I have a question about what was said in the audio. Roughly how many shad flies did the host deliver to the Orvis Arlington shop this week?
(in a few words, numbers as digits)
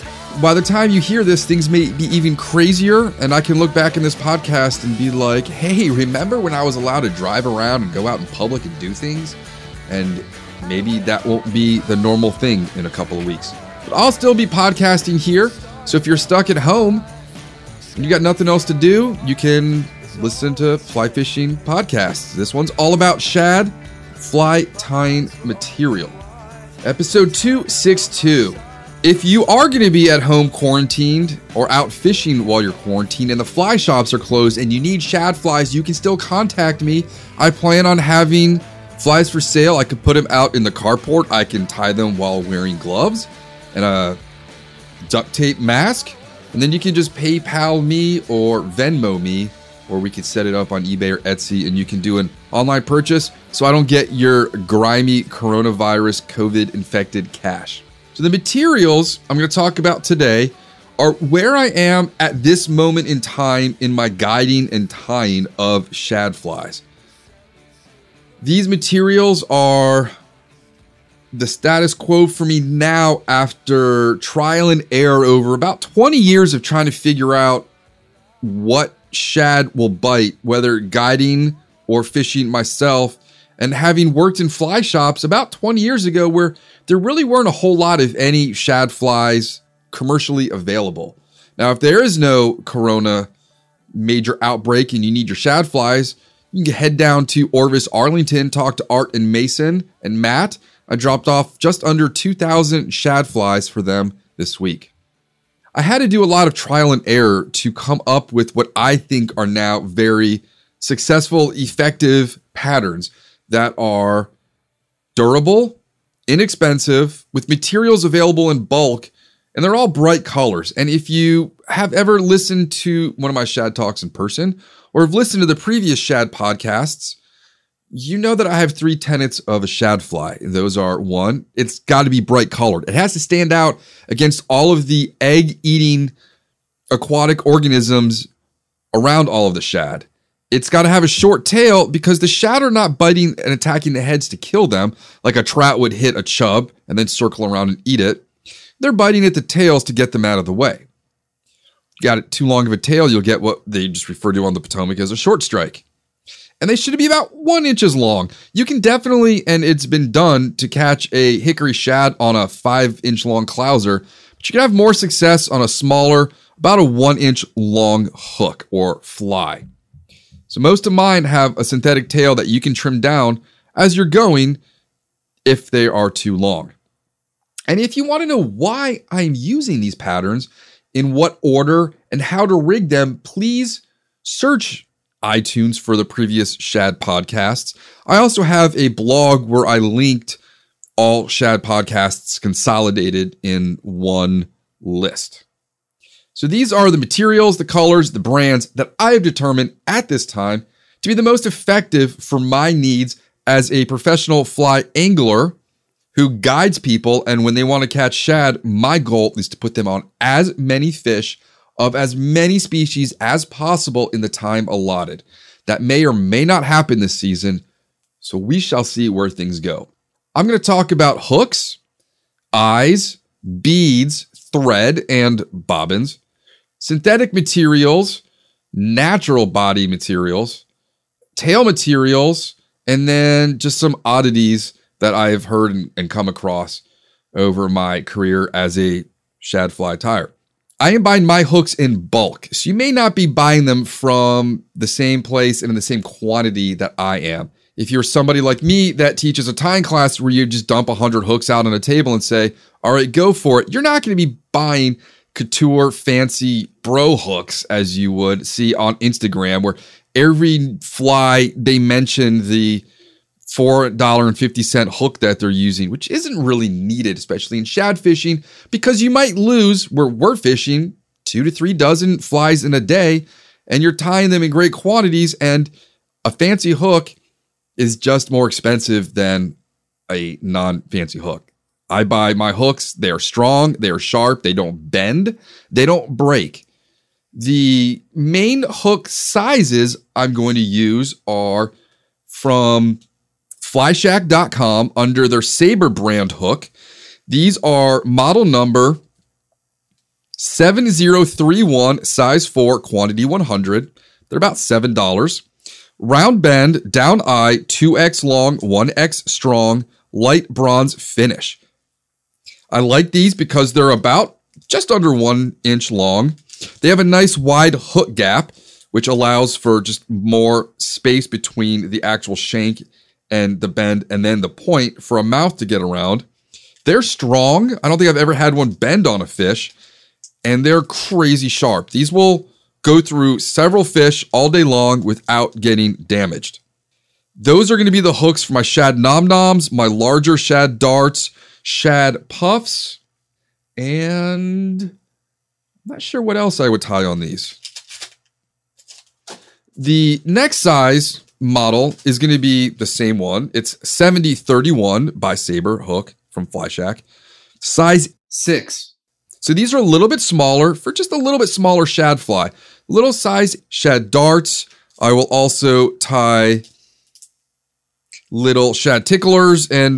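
just under 2,000.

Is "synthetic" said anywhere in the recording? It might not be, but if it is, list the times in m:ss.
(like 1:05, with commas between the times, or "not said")
2:51, 3:46.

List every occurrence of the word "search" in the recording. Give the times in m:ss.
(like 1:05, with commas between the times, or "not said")
3:04.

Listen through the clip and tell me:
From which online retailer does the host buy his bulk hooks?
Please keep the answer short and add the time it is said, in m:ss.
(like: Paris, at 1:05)
flyshack.com, at 4:53.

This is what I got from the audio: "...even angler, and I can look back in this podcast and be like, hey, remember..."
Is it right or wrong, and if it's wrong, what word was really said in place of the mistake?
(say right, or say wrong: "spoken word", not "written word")
wrong: "crazier", not "angler".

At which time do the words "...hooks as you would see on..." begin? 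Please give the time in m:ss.
4:17.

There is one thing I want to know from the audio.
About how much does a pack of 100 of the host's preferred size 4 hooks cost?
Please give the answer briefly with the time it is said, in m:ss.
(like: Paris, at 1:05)
$7, at 5:04.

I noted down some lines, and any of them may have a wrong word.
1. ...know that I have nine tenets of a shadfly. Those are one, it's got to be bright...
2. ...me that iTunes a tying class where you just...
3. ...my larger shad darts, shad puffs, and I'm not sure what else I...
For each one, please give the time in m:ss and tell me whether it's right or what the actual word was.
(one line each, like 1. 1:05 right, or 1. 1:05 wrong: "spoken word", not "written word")
1. 2:08 wrong: "three", not "nine"
2. 4:08 wrong: "teaches", not "iTunes"
3. 5:39 right.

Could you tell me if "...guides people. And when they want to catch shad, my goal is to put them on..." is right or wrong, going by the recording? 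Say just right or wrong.
right.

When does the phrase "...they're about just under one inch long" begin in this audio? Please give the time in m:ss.
5:13.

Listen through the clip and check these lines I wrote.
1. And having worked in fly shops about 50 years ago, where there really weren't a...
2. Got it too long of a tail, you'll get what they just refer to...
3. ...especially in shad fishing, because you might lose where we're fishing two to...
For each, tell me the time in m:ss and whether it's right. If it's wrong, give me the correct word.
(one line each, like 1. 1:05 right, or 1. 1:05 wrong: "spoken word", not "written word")
1. 1:23 wrong: "20", not "50"
2. 2:32 right
3. 4:27 right.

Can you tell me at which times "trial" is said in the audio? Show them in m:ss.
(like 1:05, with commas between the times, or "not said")
1:14, 1:46.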